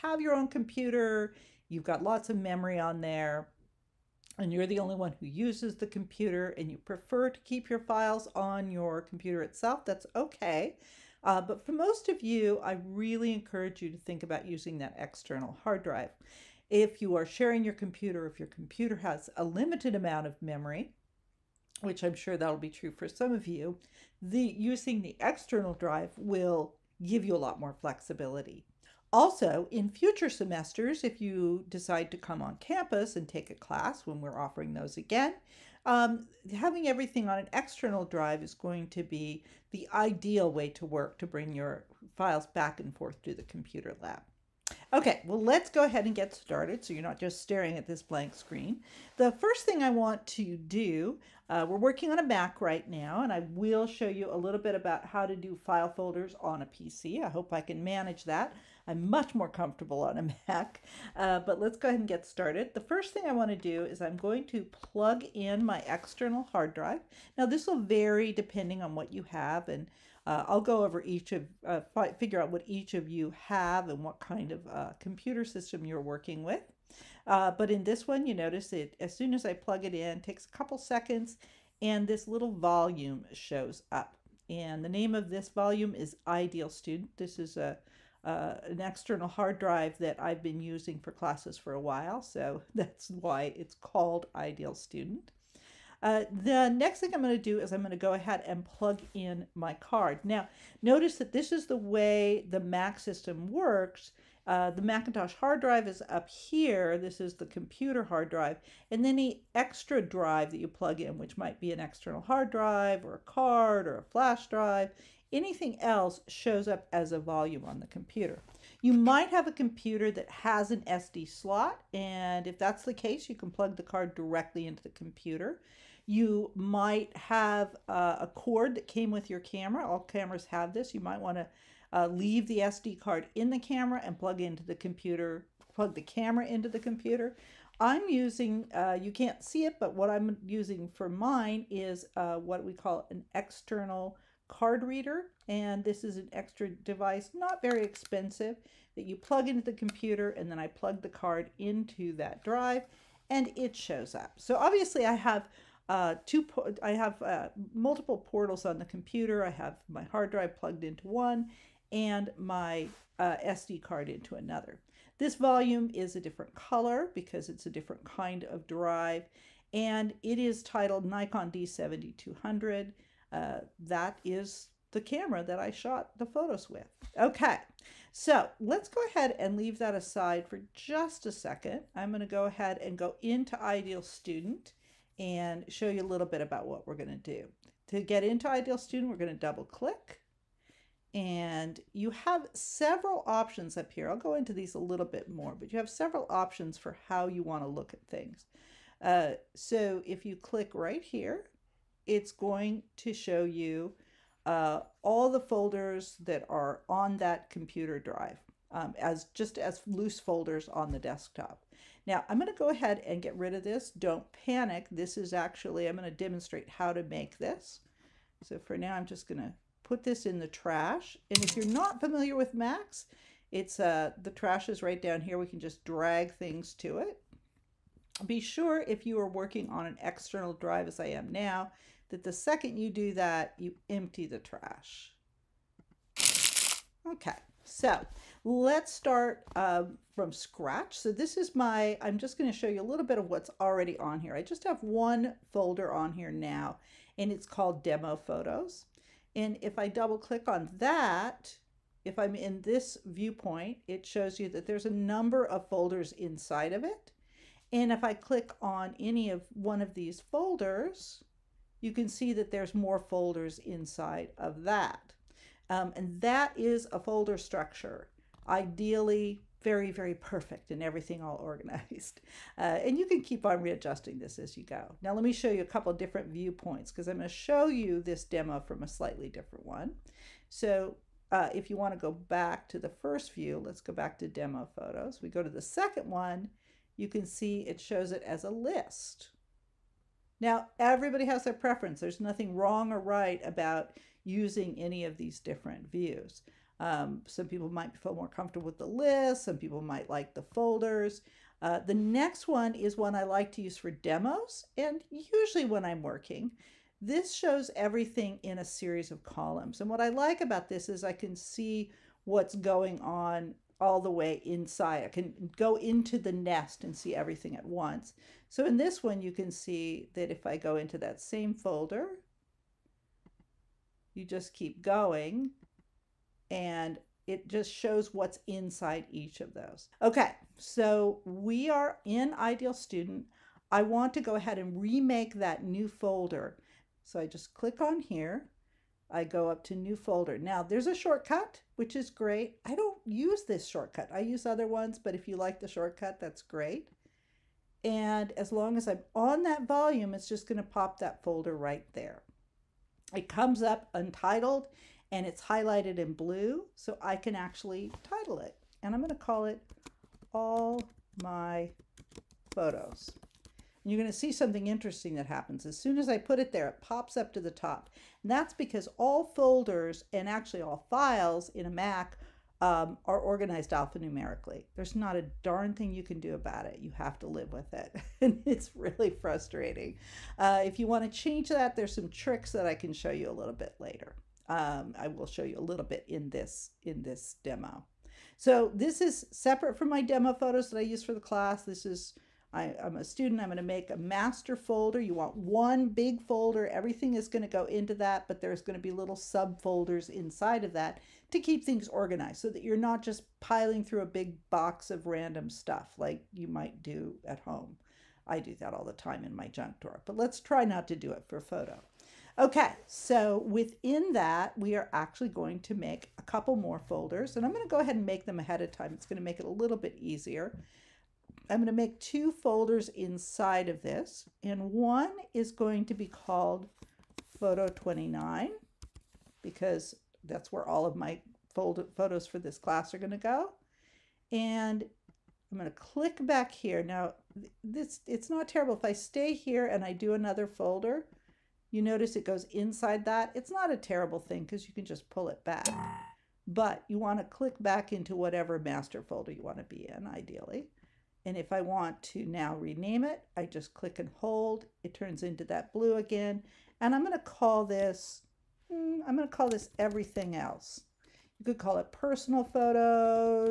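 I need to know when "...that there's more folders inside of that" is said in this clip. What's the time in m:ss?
4:22.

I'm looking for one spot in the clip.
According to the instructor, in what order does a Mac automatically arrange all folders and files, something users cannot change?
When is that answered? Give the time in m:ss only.
6:13.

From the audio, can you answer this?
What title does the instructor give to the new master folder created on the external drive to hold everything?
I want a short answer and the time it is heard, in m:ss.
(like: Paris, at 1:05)
All My Photos, at 6:00.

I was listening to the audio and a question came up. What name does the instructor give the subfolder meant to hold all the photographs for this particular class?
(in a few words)
Photo 29.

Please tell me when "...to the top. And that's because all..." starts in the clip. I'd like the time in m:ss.
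6:07.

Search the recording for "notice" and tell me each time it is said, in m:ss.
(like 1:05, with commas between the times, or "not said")
1:18, 1:40, 7:21.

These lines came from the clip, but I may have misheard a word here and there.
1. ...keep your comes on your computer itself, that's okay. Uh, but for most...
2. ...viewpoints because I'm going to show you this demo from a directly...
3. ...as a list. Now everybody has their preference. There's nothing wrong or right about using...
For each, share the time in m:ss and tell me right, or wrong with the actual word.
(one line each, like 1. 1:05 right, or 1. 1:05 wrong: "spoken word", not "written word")
1. 0:07 wrong: "files", not "comes"
2. 4:36 wrong: "slightly", not "directly"
3. 4:48 right.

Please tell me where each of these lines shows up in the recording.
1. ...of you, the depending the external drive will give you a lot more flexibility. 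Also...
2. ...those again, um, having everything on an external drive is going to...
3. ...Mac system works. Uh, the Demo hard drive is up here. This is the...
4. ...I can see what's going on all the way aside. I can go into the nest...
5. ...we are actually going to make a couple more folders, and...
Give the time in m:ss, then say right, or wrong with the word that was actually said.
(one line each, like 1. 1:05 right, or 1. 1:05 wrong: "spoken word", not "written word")
1. 0:23 wrong: "using", not "depending"
2. 0:34 right
3. 1:42 wrong: "Macintosh", not "Demo"
4. 5:11 wrong: "inside", not "aside"
5. 6:54 right.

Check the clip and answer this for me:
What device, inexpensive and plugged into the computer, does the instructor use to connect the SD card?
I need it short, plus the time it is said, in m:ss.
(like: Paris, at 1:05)
External card reader, at 2:23.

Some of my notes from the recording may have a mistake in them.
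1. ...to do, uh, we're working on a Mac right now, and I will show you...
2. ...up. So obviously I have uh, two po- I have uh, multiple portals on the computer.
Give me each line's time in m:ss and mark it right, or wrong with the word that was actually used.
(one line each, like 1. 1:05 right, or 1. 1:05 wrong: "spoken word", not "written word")
1. 0:50 right
2. 2:34 right.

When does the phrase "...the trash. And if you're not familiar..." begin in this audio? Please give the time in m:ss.
3:40.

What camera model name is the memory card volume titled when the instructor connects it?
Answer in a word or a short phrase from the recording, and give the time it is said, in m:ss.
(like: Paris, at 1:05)
Nikon D7200, at 2:51.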